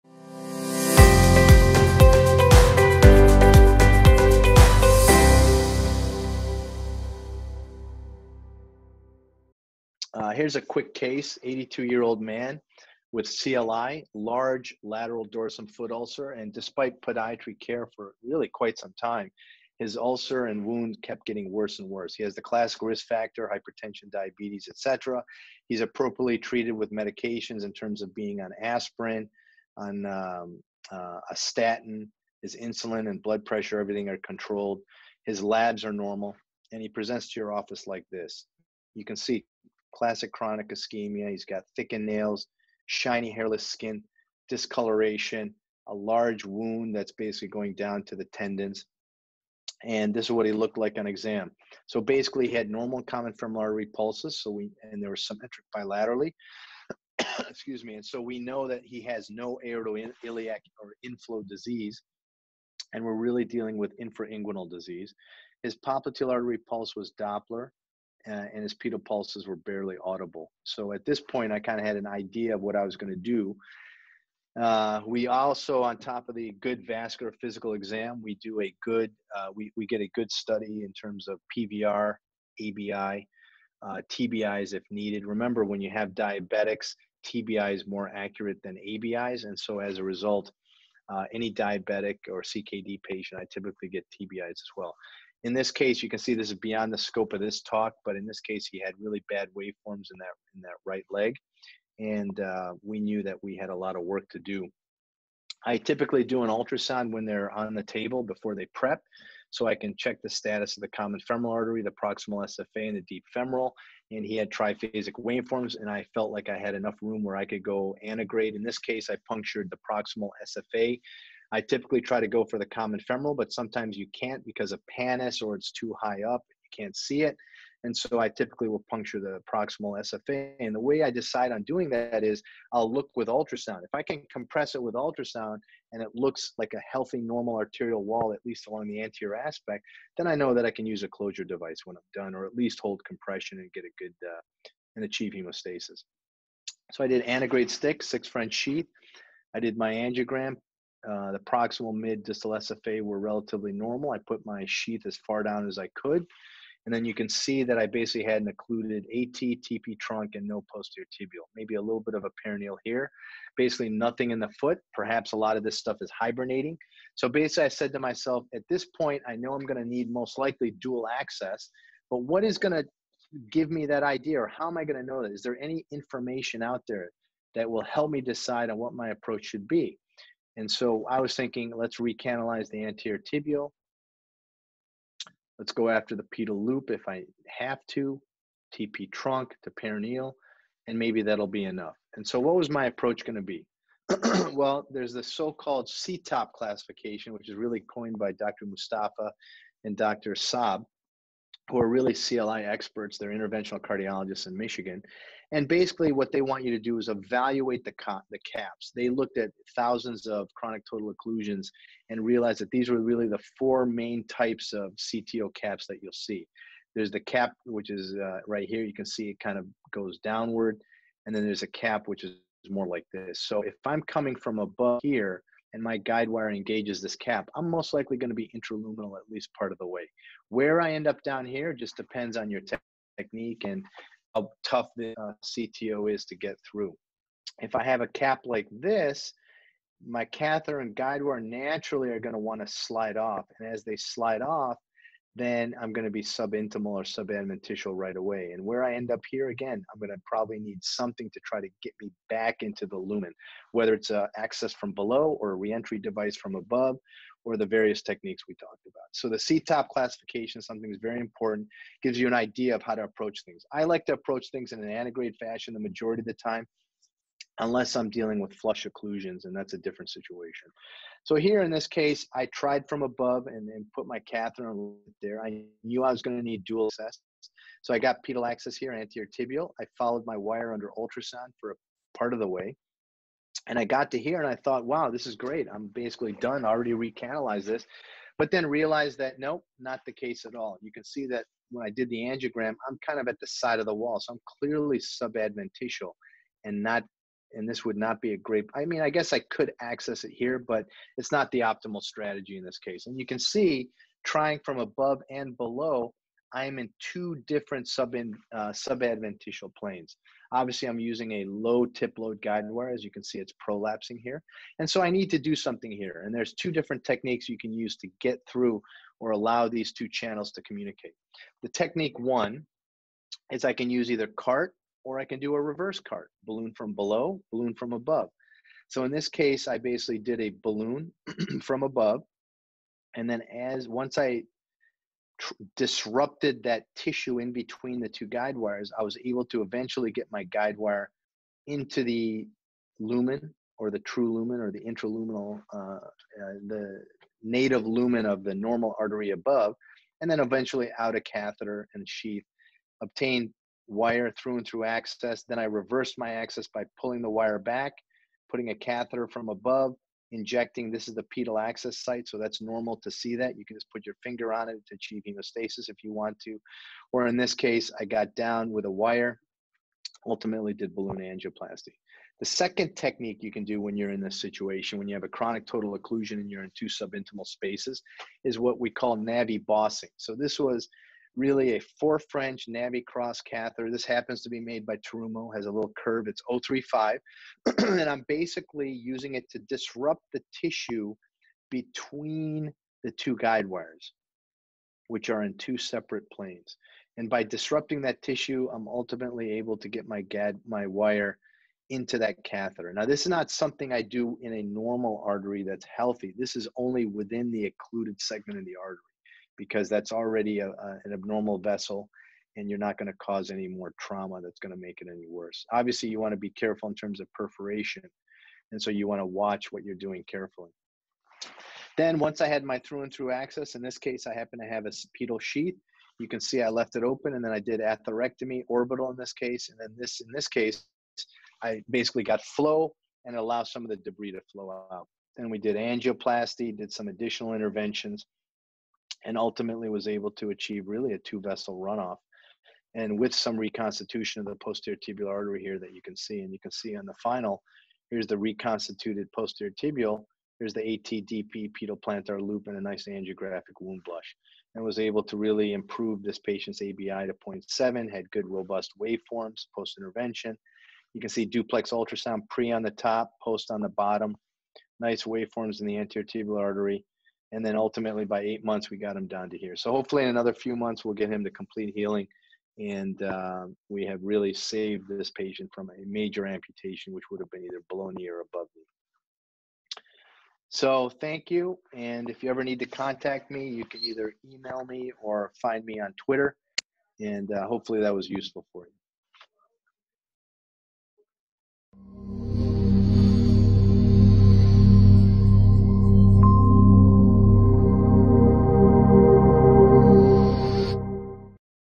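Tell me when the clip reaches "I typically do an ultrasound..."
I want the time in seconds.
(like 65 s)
105 s.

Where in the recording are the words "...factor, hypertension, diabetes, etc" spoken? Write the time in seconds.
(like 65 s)
23 s.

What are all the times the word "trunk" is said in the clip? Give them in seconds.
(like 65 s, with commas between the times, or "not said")
159 s, 189 s.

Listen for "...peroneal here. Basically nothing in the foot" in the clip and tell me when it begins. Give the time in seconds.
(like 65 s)
162 s.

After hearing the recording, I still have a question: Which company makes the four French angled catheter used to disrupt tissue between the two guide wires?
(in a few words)
Terumo.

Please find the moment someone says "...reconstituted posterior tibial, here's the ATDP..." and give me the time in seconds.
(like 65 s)
448 s.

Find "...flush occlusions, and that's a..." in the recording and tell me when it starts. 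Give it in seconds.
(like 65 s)
268 s.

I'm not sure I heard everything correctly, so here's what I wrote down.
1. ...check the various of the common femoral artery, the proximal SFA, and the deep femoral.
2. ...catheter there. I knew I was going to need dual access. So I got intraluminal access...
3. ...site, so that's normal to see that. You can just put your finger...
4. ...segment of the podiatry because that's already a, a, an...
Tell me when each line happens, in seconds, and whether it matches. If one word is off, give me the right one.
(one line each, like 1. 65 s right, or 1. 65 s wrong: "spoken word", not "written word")
1. 109 s wrong: "status", not "various"
2. 274 s wrong: "pedal", not "intraluminal"
3. 362 s right
4. 408 s wrong: "artery", not "podiatry".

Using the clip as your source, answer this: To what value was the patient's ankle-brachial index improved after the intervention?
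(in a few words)
0.7.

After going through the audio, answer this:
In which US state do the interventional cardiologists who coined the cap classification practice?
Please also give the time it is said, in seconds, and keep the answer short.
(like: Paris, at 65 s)
Michigan, at 204 s.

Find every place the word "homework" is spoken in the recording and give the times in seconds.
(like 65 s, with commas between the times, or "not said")
not said.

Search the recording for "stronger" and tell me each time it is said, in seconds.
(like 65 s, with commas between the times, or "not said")
not said.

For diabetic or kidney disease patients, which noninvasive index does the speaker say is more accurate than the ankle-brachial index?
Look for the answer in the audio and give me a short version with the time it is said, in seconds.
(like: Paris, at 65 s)
TBI, at 87 s.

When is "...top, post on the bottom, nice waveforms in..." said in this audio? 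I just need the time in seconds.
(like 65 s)
462 s.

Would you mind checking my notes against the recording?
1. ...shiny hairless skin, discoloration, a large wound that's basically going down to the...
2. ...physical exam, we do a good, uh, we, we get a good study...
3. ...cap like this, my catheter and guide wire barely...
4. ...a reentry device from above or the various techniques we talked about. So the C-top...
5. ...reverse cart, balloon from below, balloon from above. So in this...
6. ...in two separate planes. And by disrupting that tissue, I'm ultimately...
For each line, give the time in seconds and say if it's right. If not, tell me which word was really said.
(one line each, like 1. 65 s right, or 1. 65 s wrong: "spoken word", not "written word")
1. 42 s right
2. 77 s right
3. 238 s wrong: "naturally", not "barely"
4. 255 s right
5. 325 s right
6. 395 s right.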